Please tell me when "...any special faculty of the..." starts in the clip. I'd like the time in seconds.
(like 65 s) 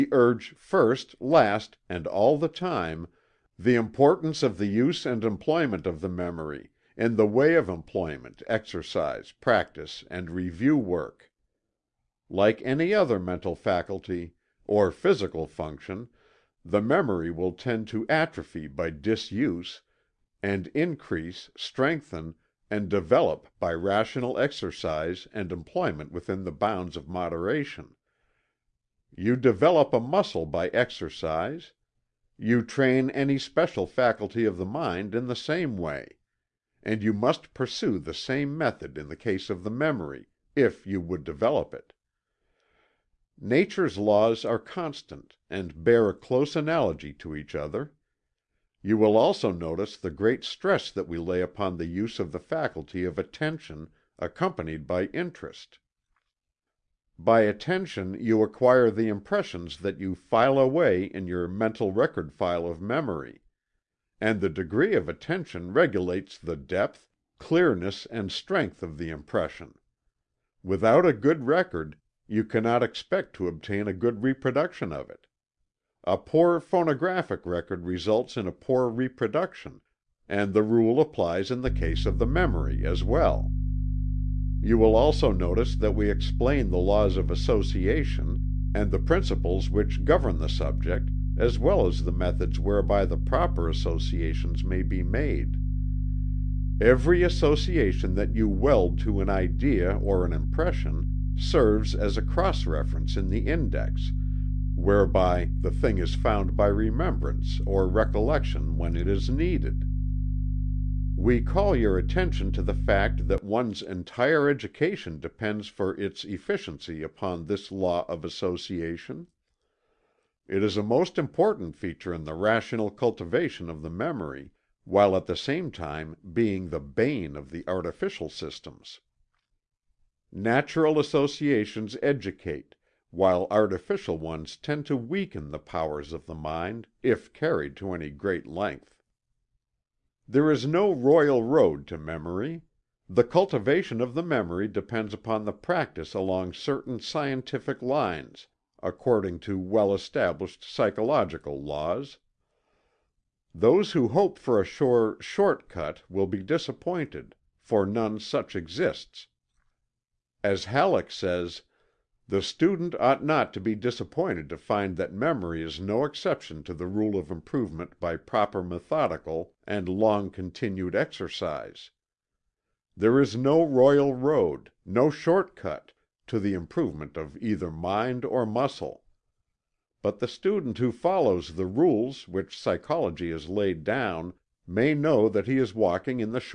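33 s.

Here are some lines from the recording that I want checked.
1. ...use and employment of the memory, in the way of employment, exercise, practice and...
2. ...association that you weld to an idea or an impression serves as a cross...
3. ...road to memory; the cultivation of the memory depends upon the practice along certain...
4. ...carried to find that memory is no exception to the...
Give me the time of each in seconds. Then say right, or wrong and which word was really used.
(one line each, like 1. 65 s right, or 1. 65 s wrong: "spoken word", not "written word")
1. 4 s right
2. 97 s right
3. 141 s right
4. 163 s wrong: "disappointed", not "carried".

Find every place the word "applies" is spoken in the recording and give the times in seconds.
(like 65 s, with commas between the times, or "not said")
81 s.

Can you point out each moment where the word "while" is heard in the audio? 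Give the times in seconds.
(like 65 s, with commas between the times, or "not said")
124 s, 133 s.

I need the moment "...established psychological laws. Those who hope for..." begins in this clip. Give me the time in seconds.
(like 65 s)
149 s.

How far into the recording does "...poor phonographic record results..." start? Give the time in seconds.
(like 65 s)
76 s.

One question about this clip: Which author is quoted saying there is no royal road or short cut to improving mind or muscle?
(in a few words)
Halleck.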